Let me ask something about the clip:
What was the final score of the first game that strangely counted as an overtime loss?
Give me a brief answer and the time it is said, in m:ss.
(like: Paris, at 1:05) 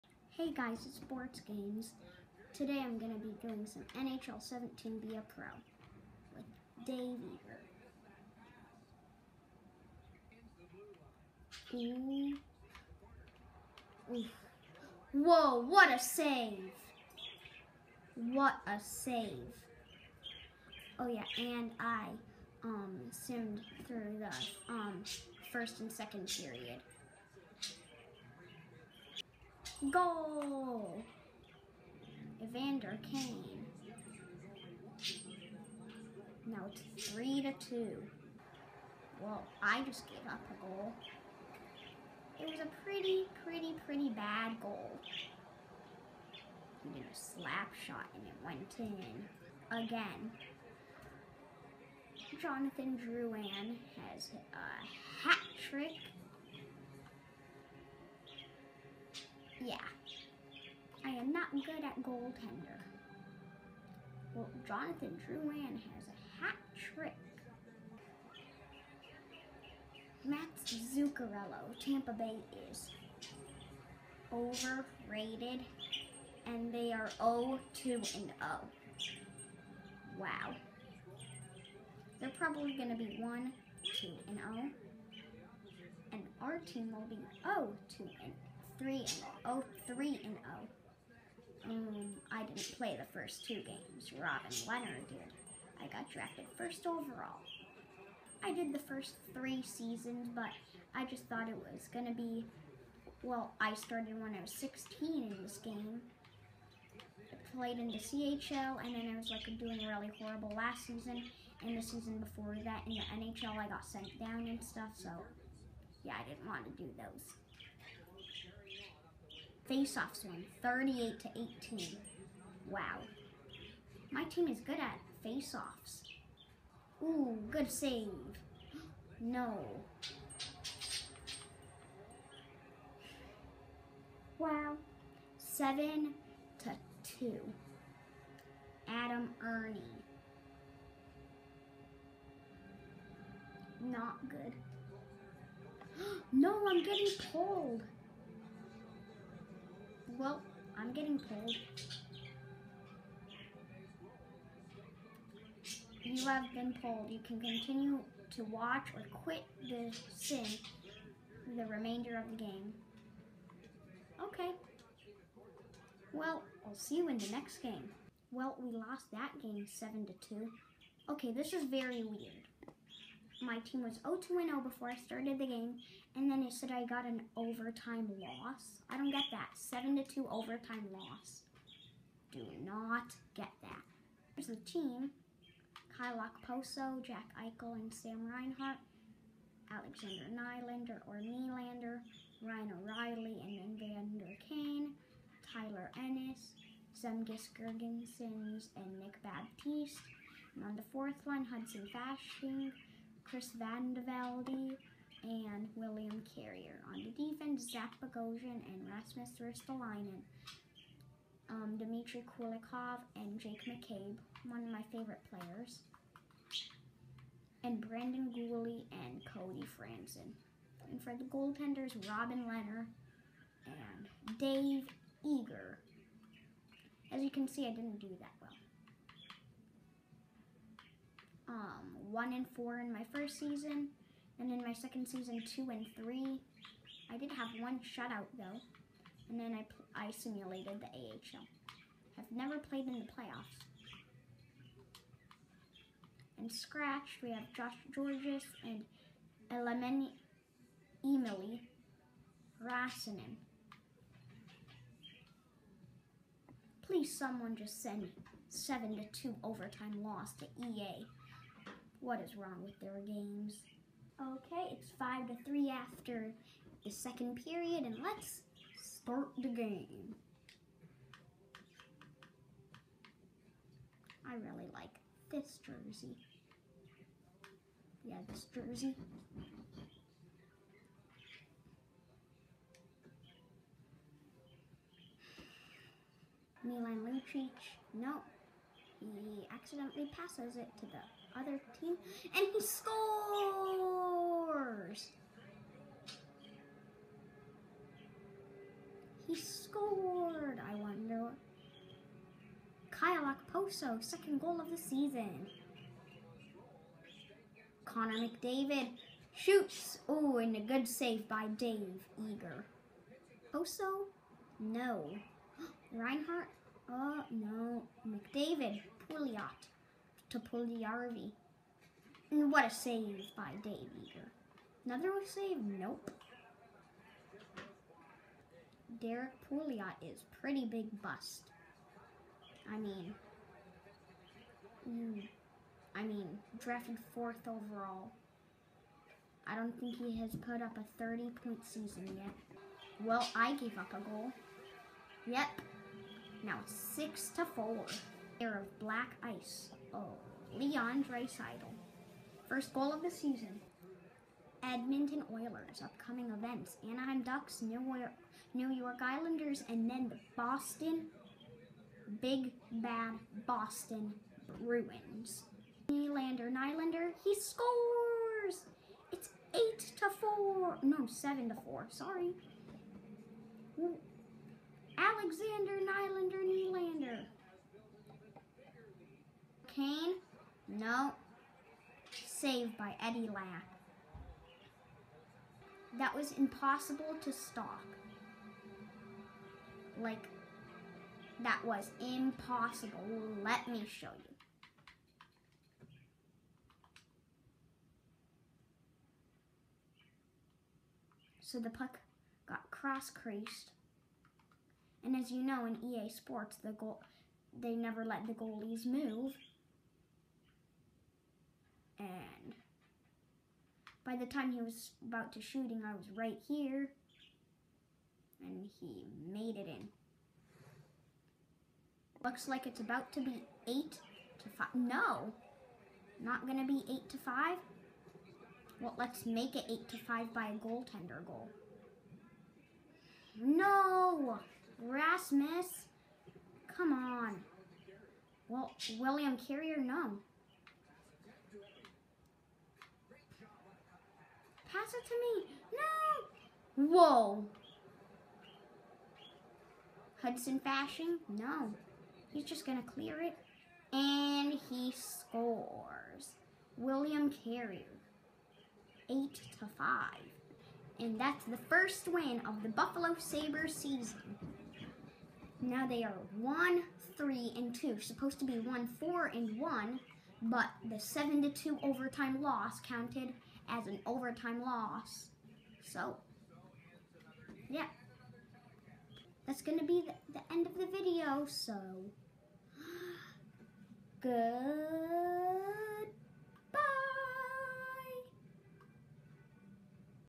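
7 to 2, at 2:48.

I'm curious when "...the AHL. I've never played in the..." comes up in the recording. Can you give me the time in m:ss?
4:00.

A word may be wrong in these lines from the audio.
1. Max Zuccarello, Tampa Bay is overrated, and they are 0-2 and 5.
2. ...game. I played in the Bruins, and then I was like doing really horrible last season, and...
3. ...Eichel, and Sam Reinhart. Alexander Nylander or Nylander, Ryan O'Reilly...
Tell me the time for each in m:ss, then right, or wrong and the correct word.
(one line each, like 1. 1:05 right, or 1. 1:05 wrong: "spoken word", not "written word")
1. 1:10 wrong: "0", not "5"
2. 1:45 wrong: "CHL", not "Bruins"
3. 3:07 right.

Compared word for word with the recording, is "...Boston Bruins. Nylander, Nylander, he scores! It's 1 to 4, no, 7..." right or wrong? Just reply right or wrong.
wrong.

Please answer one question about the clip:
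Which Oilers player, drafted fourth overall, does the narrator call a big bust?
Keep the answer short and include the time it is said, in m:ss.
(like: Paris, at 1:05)
Derek Pouliot, at 5:29.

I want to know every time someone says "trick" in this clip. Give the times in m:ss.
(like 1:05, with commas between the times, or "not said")
0:55, 1:06.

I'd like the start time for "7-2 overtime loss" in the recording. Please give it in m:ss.
2:59.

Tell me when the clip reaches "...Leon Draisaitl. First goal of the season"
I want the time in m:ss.
5:50.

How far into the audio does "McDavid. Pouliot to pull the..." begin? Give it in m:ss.
5:18.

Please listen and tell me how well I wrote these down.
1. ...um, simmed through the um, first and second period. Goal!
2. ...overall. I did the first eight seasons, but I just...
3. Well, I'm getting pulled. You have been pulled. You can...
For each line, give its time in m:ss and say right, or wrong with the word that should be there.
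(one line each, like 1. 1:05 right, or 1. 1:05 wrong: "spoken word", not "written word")
1. 0:22 right
2. 1:36 wrong: "three", not "eight"
3. 2:30 right.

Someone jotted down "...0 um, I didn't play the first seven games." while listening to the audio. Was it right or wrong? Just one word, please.
wrong.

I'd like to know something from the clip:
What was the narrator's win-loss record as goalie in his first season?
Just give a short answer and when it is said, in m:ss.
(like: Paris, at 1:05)
1 and 4, at 3:52.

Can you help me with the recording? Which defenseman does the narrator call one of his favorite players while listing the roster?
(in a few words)
Jake McCabe.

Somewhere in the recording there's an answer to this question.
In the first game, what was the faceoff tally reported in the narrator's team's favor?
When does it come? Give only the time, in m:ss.
2:00.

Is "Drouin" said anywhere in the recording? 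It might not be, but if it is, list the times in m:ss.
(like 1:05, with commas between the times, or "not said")
0:53, 1:05.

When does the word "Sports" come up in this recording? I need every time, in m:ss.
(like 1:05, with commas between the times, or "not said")
0:00, 6:46.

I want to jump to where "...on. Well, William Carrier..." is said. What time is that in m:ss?
7:16.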